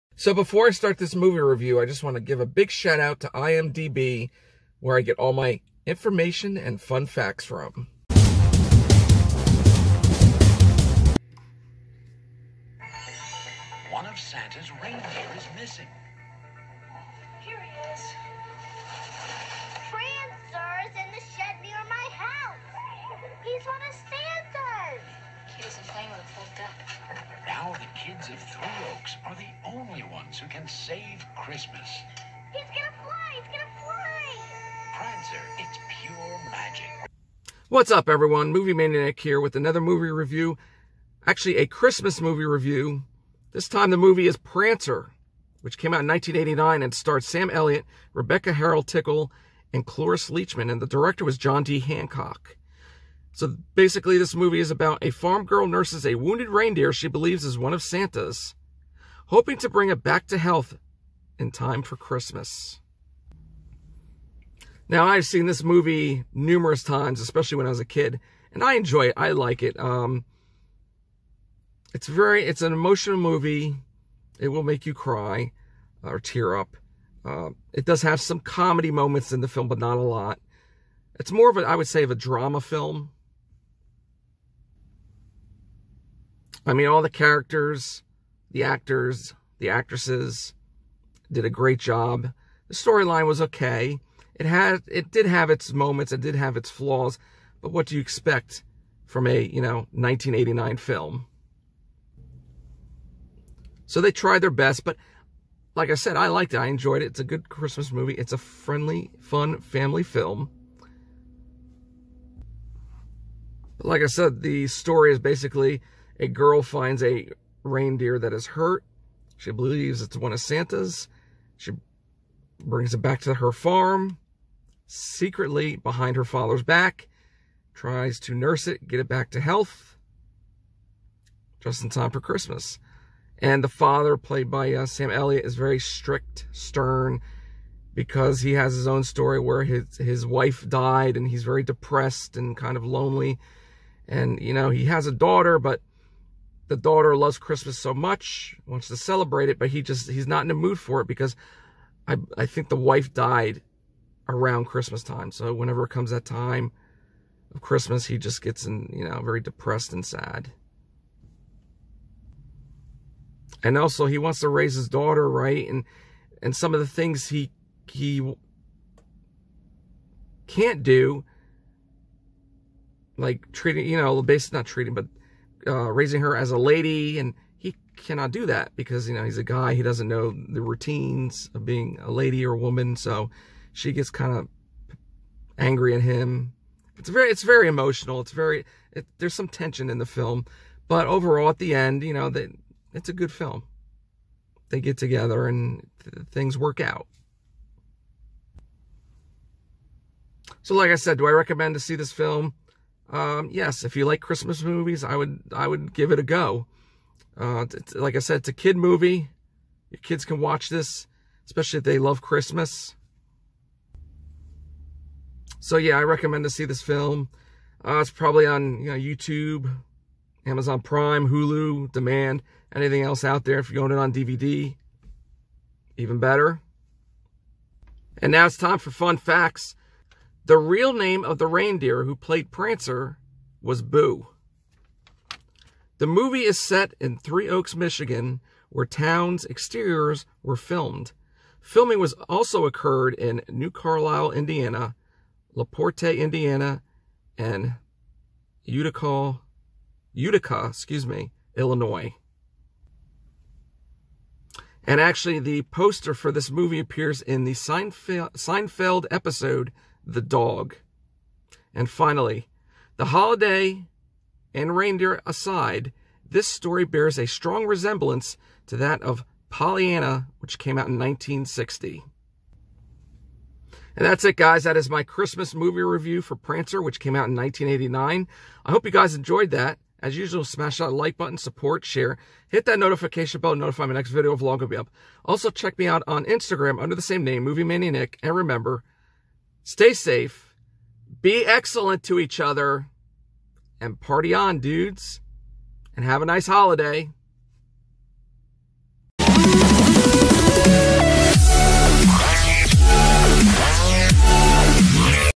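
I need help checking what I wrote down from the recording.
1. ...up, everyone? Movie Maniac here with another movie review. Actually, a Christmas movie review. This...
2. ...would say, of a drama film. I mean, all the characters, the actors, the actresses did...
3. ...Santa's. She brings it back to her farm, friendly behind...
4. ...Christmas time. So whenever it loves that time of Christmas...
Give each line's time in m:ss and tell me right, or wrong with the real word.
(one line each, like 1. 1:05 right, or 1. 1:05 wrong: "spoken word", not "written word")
1. 0:37 right
2. 1:21 right
3. 2:00 wrong: "secretly", not "friendly"
4. 2:34 wrong: "comes", not "loves".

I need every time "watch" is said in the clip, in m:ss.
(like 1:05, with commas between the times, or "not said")
3:30.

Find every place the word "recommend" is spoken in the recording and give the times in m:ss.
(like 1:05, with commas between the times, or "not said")
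3:21, 3:36.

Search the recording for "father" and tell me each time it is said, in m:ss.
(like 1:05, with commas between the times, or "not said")
2:06, 2:13.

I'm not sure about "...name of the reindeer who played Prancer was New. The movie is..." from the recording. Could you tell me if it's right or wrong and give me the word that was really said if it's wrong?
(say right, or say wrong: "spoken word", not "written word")
wrong: "Boo", not "New".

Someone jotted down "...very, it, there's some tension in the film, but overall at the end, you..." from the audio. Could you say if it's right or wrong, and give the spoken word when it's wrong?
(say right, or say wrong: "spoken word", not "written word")
right.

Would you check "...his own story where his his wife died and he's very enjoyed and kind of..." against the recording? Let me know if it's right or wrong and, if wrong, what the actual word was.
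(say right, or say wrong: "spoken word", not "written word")
wrong: "depressed", not "enjoyed".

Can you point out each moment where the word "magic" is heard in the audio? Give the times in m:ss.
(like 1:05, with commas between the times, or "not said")
0:36.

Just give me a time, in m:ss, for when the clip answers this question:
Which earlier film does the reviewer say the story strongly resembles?
4:29.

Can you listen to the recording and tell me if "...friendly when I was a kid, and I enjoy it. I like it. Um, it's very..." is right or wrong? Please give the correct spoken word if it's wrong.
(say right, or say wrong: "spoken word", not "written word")
wrong: "especially", not "friendly".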